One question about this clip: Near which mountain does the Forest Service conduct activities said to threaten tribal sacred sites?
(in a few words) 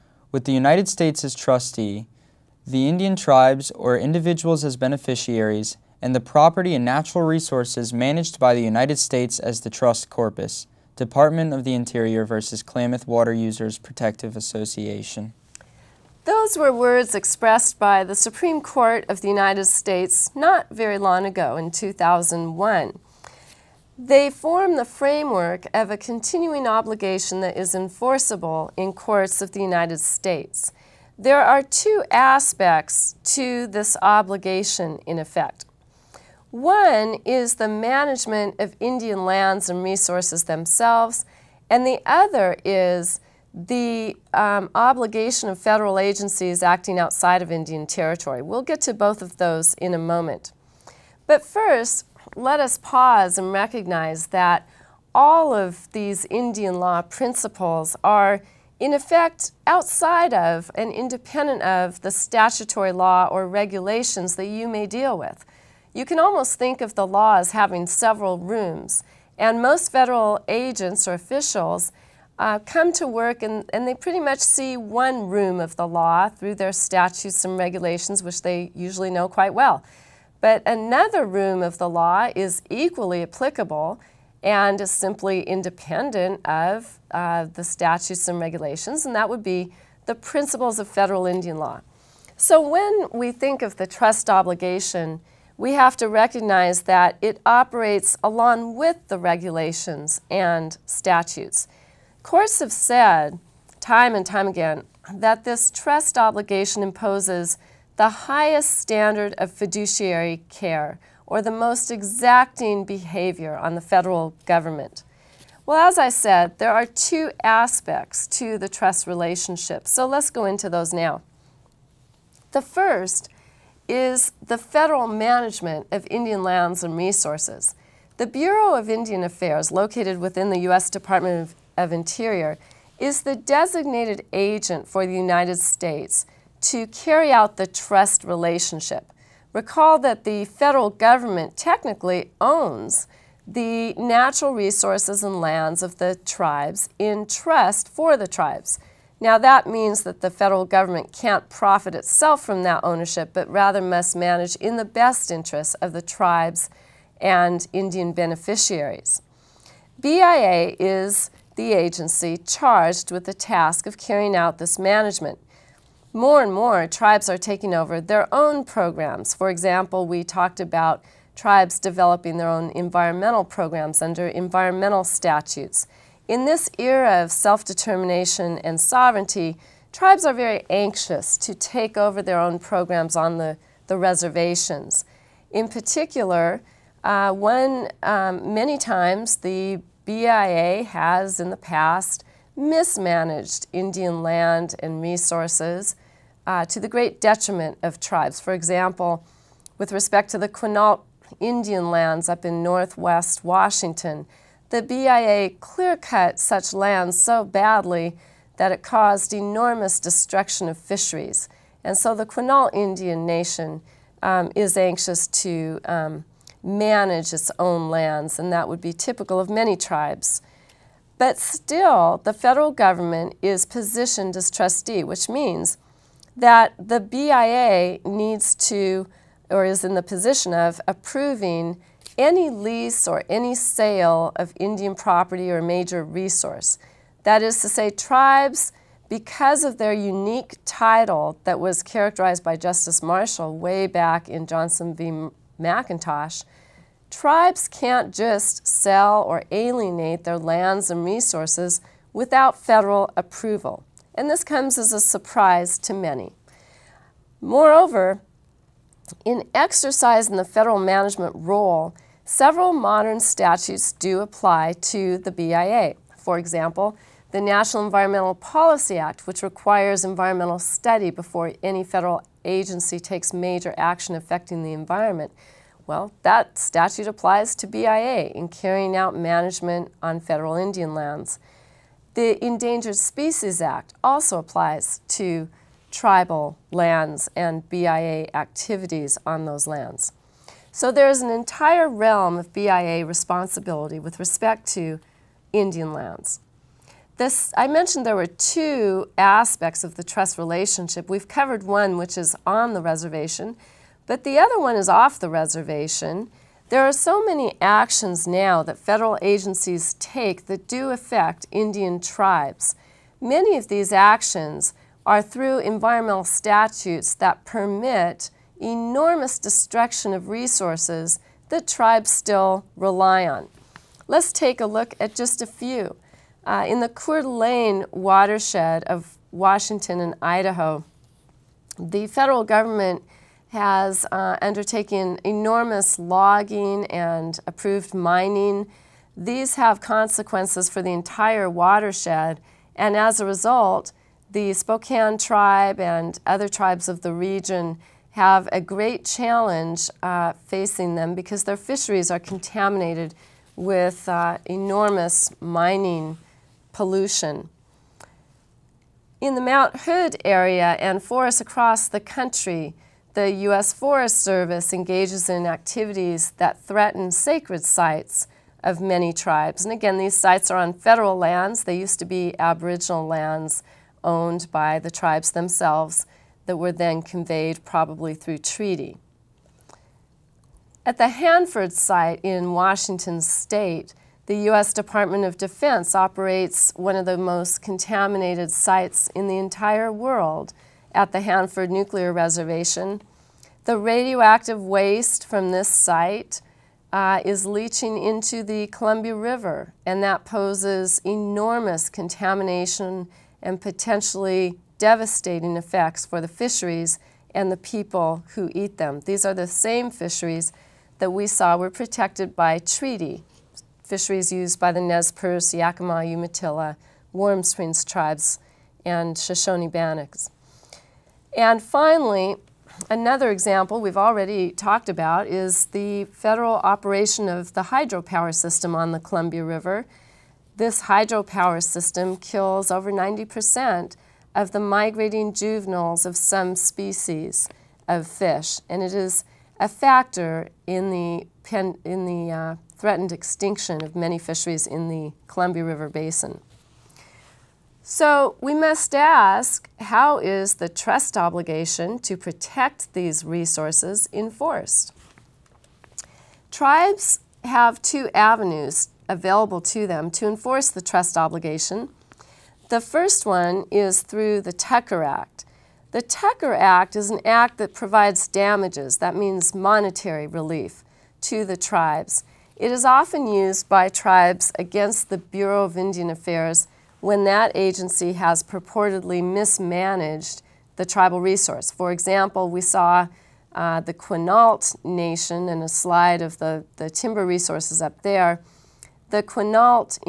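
Mount Hood.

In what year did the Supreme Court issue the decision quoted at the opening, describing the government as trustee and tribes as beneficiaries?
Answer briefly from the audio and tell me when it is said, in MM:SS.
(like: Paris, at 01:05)
2001, at 00:21.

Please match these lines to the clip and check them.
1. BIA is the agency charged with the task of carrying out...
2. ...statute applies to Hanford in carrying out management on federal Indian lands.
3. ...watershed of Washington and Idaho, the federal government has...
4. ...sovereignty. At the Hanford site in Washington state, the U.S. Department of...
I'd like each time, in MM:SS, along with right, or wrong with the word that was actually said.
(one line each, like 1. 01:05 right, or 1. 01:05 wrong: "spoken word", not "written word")
1. 02:39 right
2. 04:36 wrong: "BIA", not "Hanford"
3. 05:27 right
4. 06:18 wrong: "treaty", not "sovereignty".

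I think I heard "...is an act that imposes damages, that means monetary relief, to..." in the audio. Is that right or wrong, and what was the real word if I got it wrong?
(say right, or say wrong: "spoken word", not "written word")
wrong: "provides", not "imposes".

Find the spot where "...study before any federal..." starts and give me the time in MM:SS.
04:30.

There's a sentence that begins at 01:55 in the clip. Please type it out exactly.
Well, as I said, there are two aspects to the trust relationship, so let's go into those now.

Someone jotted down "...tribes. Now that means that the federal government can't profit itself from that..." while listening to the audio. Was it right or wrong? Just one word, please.
right.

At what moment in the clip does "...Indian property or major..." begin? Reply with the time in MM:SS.
03:54.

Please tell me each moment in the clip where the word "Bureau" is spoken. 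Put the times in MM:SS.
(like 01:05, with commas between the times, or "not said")
02:08, 07:55.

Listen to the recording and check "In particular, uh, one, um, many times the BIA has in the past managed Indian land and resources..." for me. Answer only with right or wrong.
wrong.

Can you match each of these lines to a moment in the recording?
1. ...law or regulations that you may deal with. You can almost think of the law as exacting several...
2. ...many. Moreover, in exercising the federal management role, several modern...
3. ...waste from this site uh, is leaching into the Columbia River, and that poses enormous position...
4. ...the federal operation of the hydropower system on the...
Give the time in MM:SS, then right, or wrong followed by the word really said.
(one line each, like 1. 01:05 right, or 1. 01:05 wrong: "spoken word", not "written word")
1. 01:02 wrong: "having", not "exacting"
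2. 04:15 right
3. 06:34 wrong: "contamination", not "position"
4. 07:05 right.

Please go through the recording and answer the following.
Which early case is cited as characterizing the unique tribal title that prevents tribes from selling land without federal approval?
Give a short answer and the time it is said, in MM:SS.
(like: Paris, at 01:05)
Johnson v. McIntosh, at 04:04.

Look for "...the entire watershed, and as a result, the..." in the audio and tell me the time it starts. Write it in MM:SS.
05:40.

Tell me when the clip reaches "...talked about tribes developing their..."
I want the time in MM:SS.
02:50.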